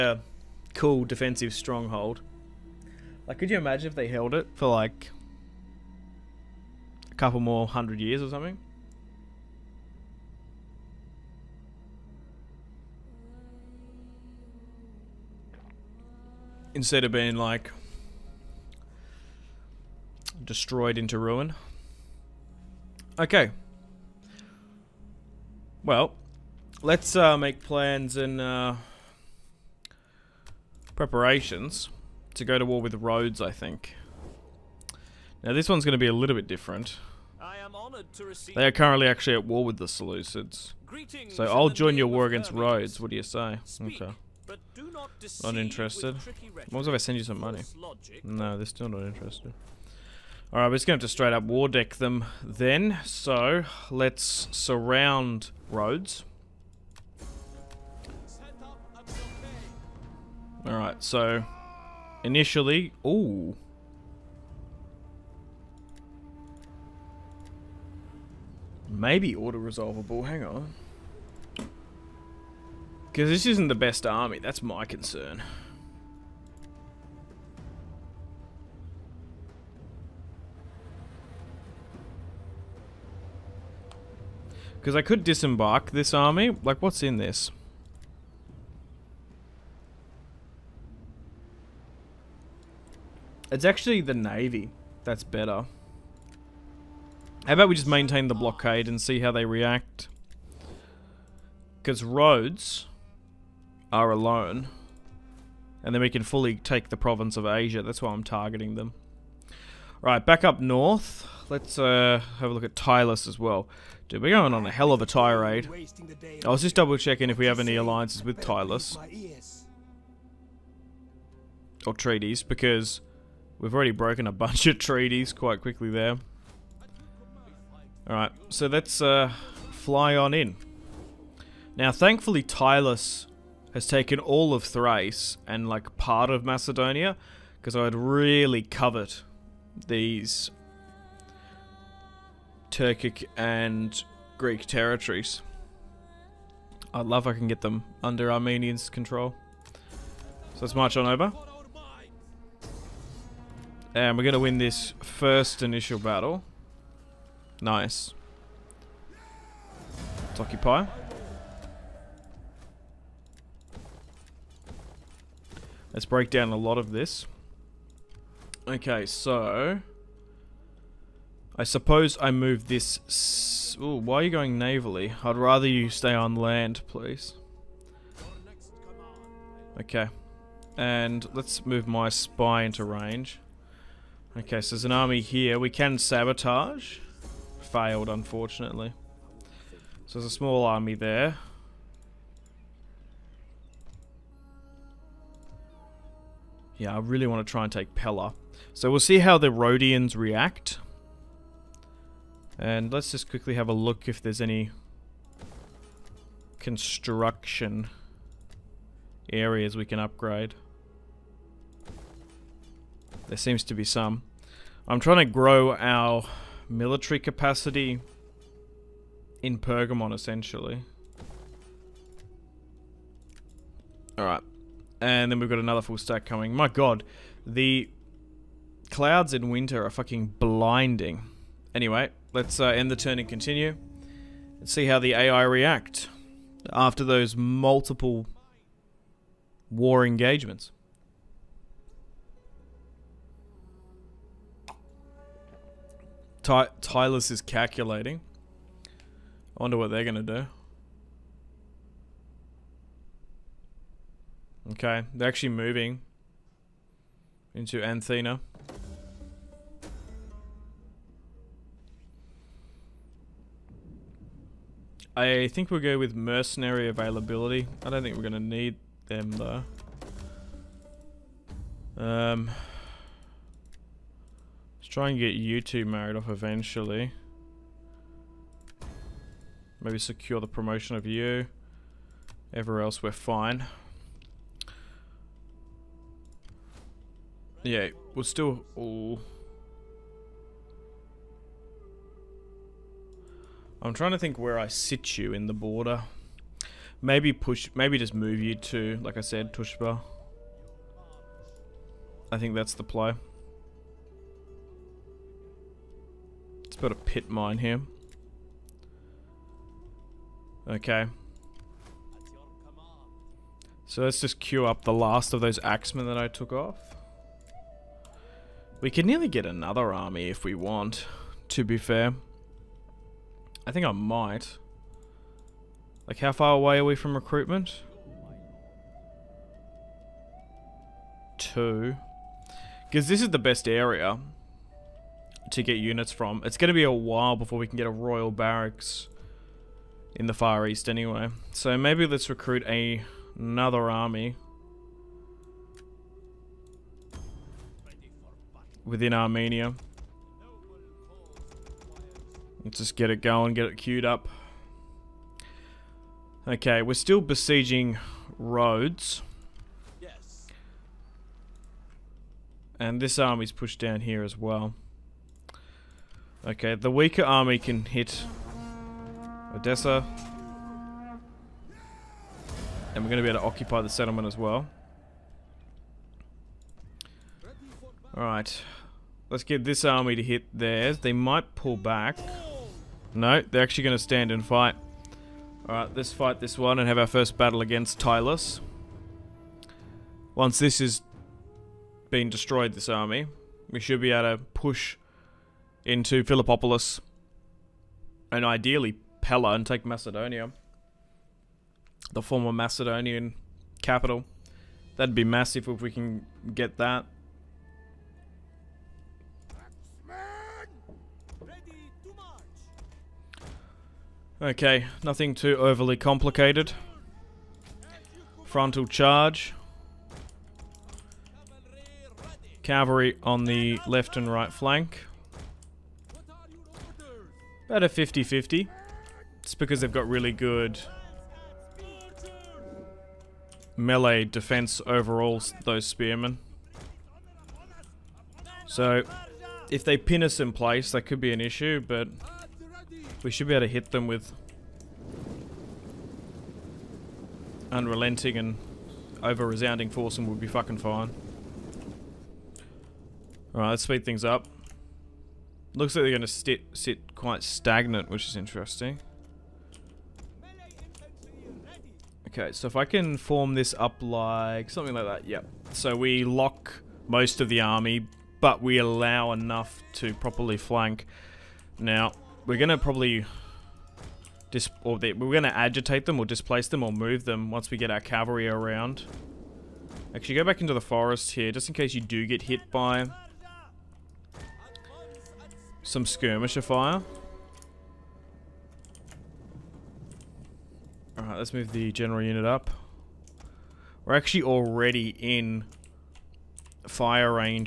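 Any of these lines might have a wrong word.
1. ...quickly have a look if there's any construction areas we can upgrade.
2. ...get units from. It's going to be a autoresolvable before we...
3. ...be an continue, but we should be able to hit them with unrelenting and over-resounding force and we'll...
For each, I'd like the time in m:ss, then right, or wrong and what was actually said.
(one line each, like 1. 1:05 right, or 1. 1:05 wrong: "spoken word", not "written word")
1. 3:23 right
2. 5:35 wrong: "while", not "autoresolvable"
3. 7:21 wrong: "issue", not "continue".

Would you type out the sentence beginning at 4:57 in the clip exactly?
Maybe push, maybe just move you to, like I said, Tushpa.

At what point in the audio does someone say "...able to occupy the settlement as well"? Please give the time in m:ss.
6:13.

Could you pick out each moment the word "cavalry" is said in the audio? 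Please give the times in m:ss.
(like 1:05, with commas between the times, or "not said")
7:02, 7:57.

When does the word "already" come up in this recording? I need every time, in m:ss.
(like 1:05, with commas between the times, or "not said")
2:03, 8:14.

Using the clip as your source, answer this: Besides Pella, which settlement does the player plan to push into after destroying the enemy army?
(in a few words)
Philippopolis.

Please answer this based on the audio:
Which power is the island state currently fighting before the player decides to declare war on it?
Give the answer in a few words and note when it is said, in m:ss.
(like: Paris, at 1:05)
The Seleucids, at 0:39.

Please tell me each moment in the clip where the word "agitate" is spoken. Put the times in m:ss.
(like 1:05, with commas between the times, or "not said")
7:55.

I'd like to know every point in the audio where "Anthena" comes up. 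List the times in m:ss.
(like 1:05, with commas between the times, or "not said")
4:17.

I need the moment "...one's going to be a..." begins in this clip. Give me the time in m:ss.
0:35.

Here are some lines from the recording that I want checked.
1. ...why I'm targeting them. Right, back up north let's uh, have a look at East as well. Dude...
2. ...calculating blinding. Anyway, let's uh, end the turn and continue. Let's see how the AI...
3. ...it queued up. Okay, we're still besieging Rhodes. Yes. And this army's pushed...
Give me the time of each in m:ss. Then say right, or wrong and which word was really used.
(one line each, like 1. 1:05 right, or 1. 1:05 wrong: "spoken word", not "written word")
1. 1:48 wrong: "Tylis", not "East"
2. 3:49 wrong: "fucking", not "calculating"
3. 5:53 right.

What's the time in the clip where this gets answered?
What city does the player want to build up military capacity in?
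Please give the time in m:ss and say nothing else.
3:39.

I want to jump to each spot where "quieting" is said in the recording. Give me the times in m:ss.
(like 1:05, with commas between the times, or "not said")
not said.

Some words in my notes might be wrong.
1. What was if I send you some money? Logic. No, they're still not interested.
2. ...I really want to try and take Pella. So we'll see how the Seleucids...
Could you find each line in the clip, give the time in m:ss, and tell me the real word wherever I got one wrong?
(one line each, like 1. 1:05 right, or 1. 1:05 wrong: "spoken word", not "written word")
1. 0:46 right
2. 3:16 wrong: "Rhodians", not "Seleucids".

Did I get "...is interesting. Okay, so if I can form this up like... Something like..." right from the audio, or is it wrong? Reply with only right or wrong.
right.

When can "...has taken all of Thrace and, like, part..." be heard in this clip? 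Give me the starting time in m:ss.
2:13.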